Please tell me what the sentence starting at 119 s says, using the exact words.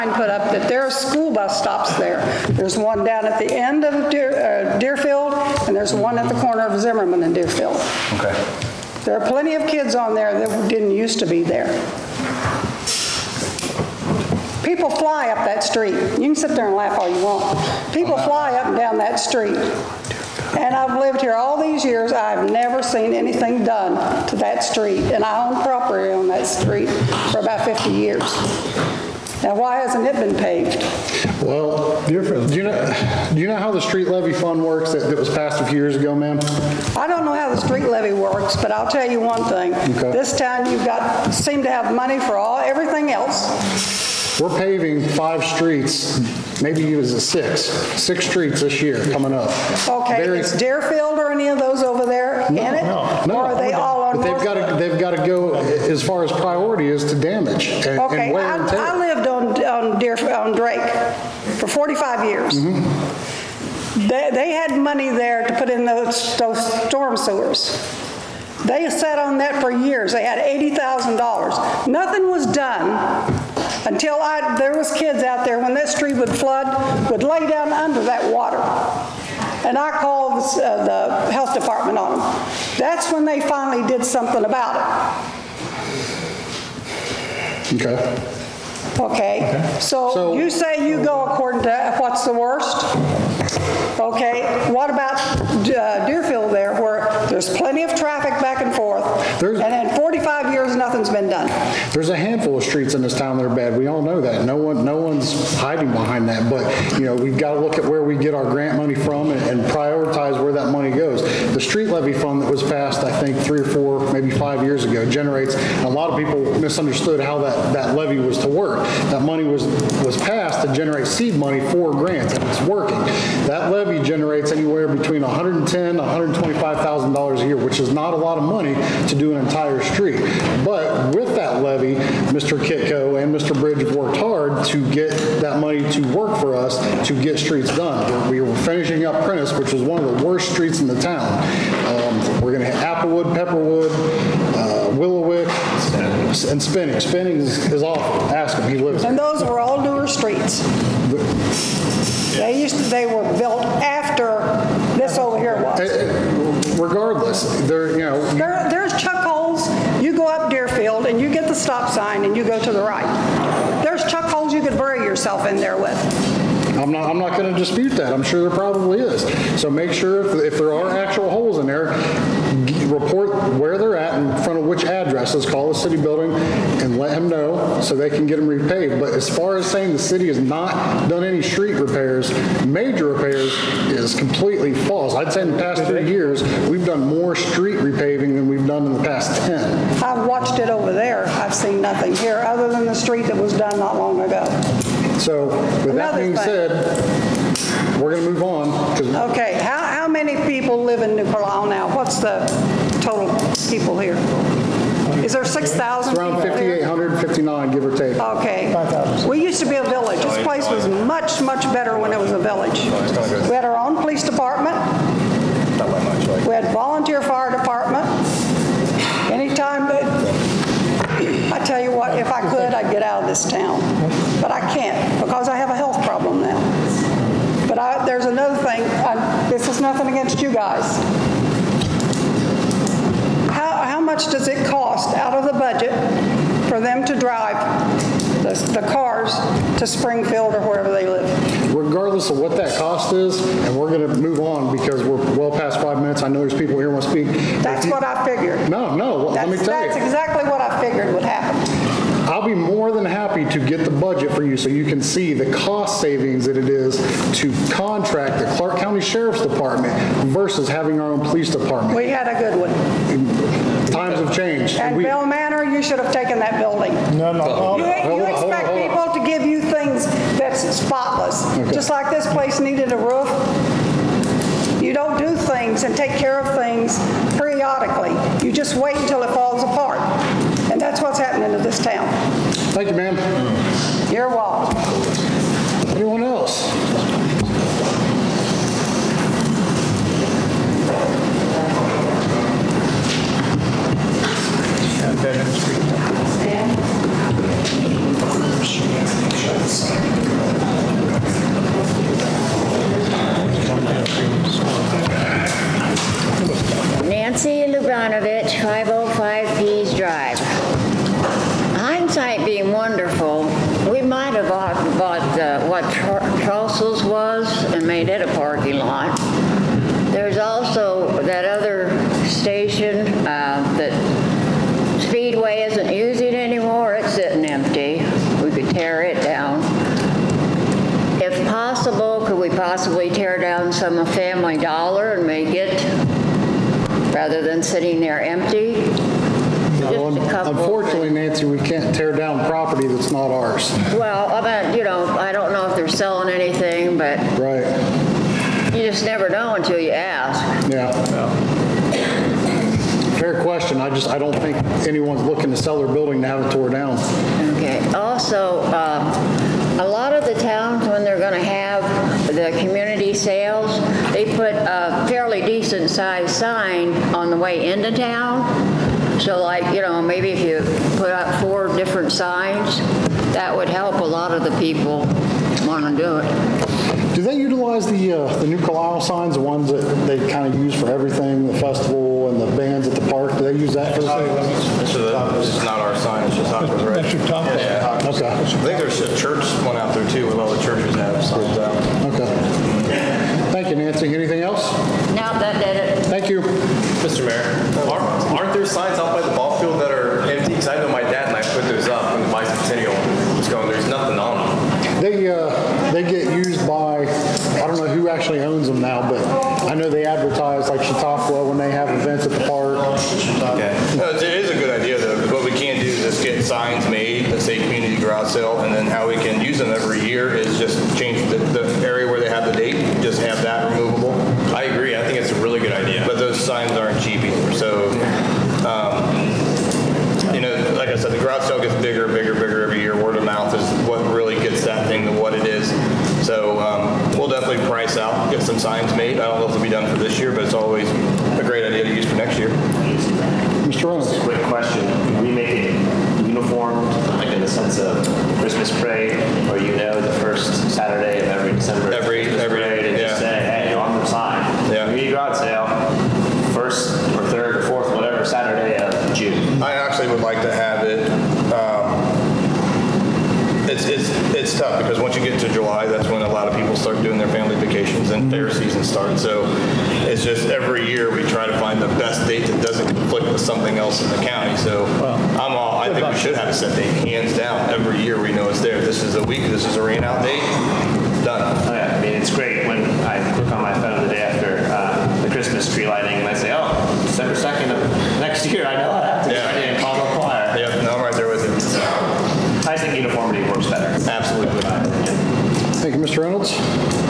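That money was, was passed to generate seed money for grants, and it's working.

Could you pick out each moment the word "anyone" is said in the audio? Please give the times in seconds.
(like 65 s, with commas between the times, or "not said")
354 s.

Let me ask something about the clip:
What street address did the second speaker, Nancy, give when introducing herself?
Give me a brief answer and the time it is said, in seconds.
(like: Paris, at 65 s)
505 Pease Drive, at 308 s.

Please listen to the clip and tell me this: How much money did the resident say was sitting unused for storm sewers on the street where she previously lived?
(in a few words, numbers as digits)
$80,000.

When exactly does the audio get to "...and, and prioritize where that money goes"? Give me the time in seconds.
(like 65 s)
109 s.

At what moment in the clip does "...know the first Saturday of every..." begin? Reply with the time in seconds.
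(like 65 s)
449 s.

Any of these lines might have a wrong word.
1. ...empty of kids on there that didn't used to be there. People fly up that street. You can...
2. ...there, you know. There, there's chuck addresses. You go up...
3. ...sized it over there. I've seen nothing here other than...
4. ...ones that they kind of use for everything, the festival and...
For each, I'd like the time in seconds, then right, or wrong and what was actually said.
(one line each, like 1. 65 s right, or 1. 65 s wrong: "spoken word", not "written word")
1. 9 s wrong: "plenty", not "empty"
2. 157 s wrong: "holes", not "addresses"
3. 190 s wrong: "watched", not "sized"
4. 379 s right.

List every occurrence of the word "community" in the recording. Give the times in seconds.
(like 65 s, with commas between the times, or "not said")
362 s, 417 s.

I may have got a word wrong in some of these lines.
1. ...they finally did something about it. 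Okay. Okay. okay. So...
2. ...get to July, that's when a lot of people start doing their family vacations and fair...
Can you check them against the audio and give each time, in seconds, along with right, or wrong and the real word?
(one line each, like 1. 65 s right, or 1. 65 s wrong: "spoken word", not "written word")
1. 83 s right
2. 465 s right.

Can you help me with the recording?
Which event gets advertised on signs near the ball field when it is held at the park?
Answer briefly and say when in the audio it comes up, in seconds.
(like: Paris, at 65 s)
Chautauqua, at 410 s.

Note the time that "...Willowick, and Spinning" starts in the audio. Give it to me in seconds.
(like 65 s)
144 s.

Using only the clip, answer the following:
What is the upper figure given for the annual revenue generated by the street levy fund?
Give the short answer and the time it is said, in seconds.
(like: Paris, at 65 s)
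$125,000, at 126 s.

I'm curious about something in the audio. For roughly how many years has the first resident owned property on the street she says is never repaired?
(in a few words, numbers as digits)
50.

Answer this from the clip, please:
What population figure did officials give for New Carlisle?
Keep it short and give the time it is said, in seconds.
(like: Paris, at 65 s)
5,859, at 206 s.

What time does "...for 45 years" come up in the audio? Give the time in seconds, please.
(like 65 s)
61 s.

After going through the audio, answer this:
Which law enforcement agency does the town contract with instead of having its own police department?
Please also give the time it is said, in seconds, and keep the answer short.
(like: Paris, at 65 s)
Clark County Sheriff's Department, at 258 s.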